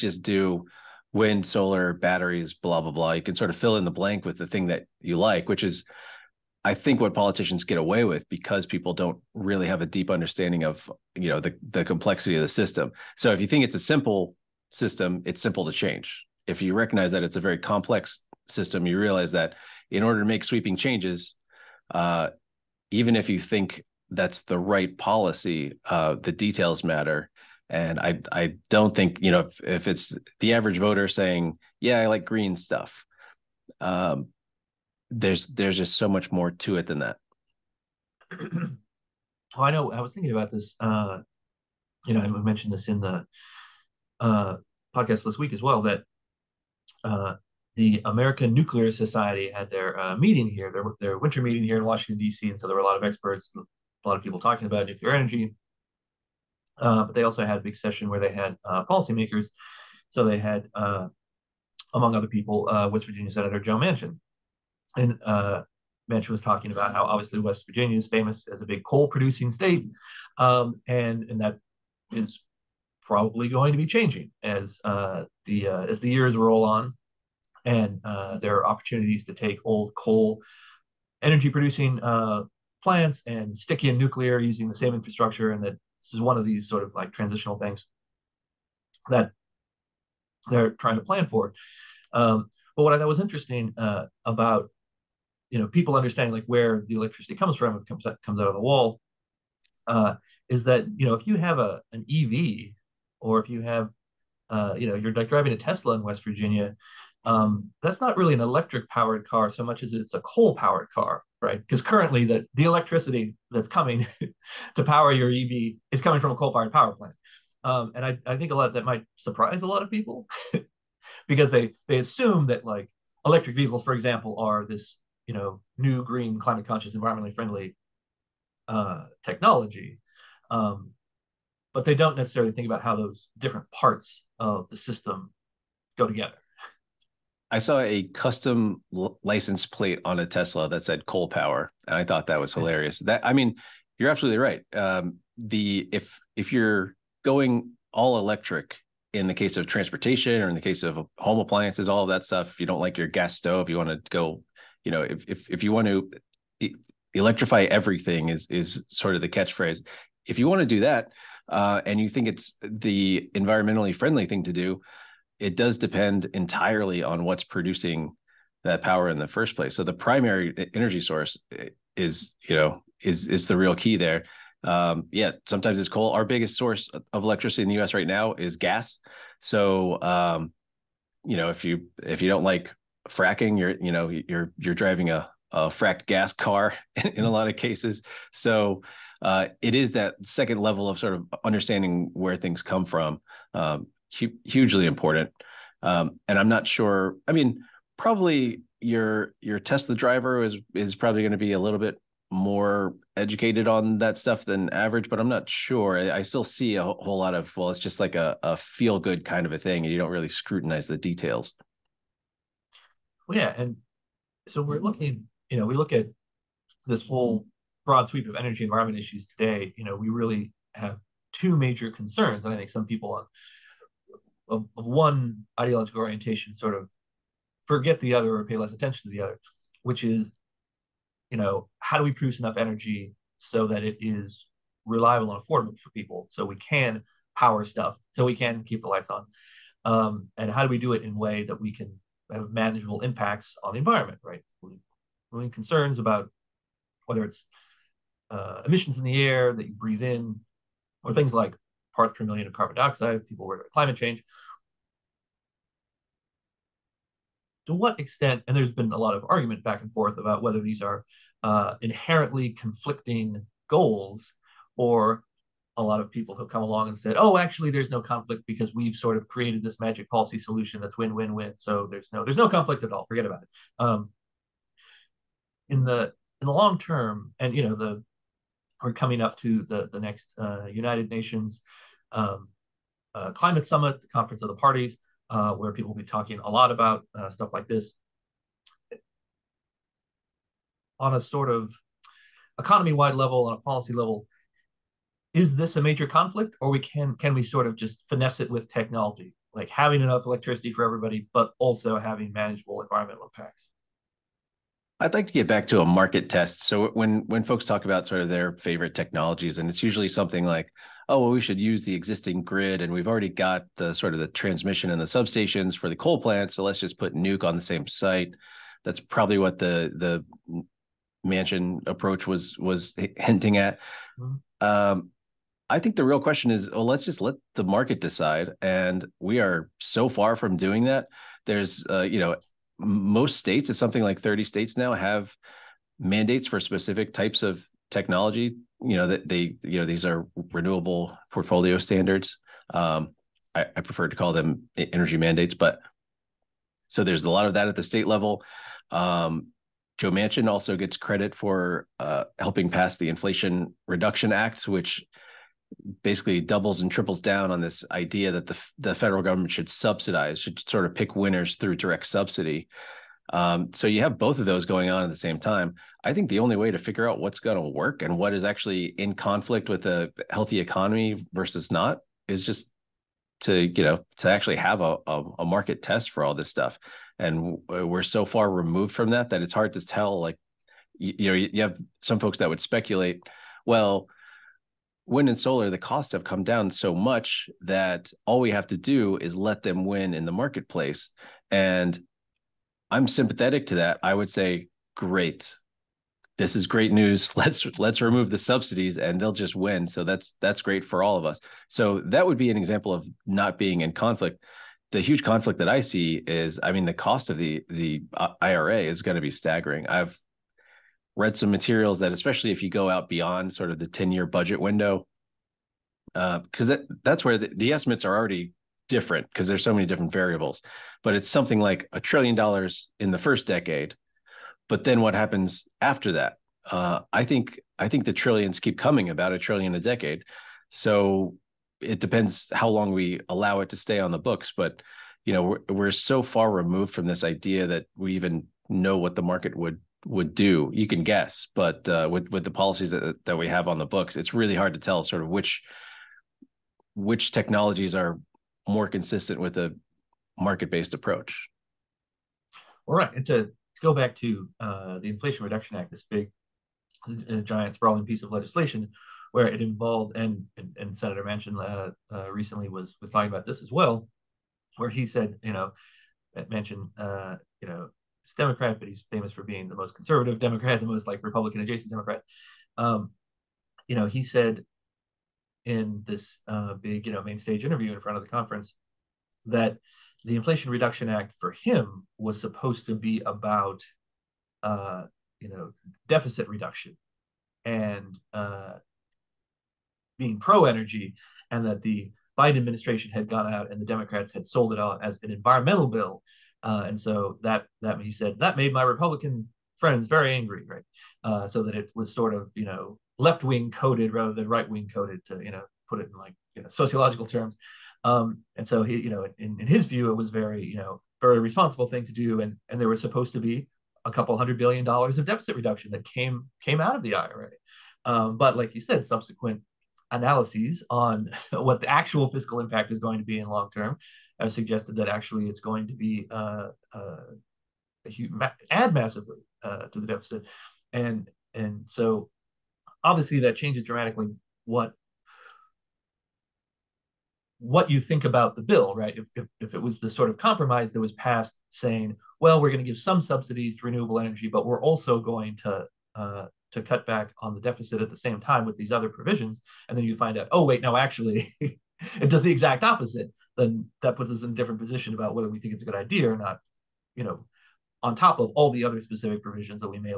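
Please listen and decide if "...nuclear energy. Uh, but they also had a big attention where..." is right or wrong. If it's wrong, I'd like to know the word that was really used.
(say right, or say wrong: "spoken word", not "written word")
wrong: "session", not "attention".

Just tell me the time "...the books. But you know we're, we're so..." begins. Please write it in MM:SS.
07:14.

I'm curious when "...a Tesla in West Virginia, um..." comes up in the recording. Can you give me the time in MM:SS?
01:45.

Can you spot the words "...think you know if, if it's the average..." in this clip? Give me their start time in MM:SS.
00:28.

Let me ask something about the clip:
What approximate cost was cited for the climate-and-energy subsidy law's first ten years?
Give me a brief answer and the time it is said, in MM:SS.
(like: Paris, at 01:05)
a trillion dollars, at 07:01.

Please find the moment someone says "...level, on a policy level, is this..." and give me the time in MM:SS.
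04:53.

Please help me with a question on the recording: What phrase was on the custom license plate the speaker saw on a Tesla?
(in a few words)
coal power.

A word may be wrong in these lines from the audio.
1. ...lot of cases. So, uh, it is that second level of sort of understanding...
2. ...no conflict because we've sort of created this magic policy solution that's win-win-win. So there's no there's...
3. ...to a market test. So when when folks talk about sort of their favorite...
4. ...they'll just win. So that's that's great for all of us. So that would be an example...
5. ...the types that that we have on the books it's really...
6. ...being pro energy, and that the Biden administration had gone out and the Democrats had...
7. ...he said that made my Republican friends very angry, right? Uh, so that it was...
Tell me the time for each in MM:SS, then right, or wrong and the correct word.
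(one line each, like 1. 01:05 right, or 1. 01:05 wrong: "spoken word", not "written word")
1. 03:07 right
2. 04:27 right
3. 05:05 right
4. 06:39 right
5. 07:22 wrong: "policies", not "types"
6. 08:10 right
7. 08:18 right.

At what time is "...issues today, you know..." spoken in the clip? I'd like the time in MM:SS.
03:38.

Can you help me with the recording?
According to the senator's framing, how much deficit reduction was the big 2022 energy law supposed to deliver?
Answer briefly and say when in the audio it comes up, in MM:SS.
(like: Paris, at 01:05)
a couple hundred billion dollars, at 08:34.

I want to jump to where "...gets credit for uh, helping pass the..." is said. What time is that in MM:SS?
05:50.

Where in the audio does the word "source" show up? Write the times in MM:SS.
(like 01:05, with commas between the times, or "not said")
02:51, 02:56.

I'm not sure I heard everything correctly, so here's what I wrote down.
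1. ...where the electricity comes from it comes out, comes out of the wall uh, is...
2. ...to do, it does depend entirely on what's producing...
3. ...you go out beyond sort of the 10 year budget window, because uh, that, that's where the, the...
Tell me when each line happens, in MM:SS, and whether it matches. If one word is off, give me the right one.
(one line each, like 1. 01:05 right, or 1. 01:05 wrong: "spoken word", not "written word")
1. 01:36 right
2. 02:44 right
3. 06:52 right.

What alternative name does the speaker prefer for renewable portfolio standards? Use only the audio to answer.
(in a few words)
energy mandates.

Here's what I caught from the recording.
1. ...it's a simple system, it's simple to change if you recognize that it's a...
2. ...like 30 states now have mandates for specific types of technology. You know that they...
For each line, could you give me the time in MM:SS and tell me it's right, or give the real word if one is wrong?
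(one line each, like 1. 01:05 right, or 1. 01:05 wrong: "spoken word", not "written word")
1. 00:13 right
2. 05:34 right.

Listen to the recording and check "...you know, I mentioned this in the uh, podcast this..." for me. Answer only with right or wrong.
right.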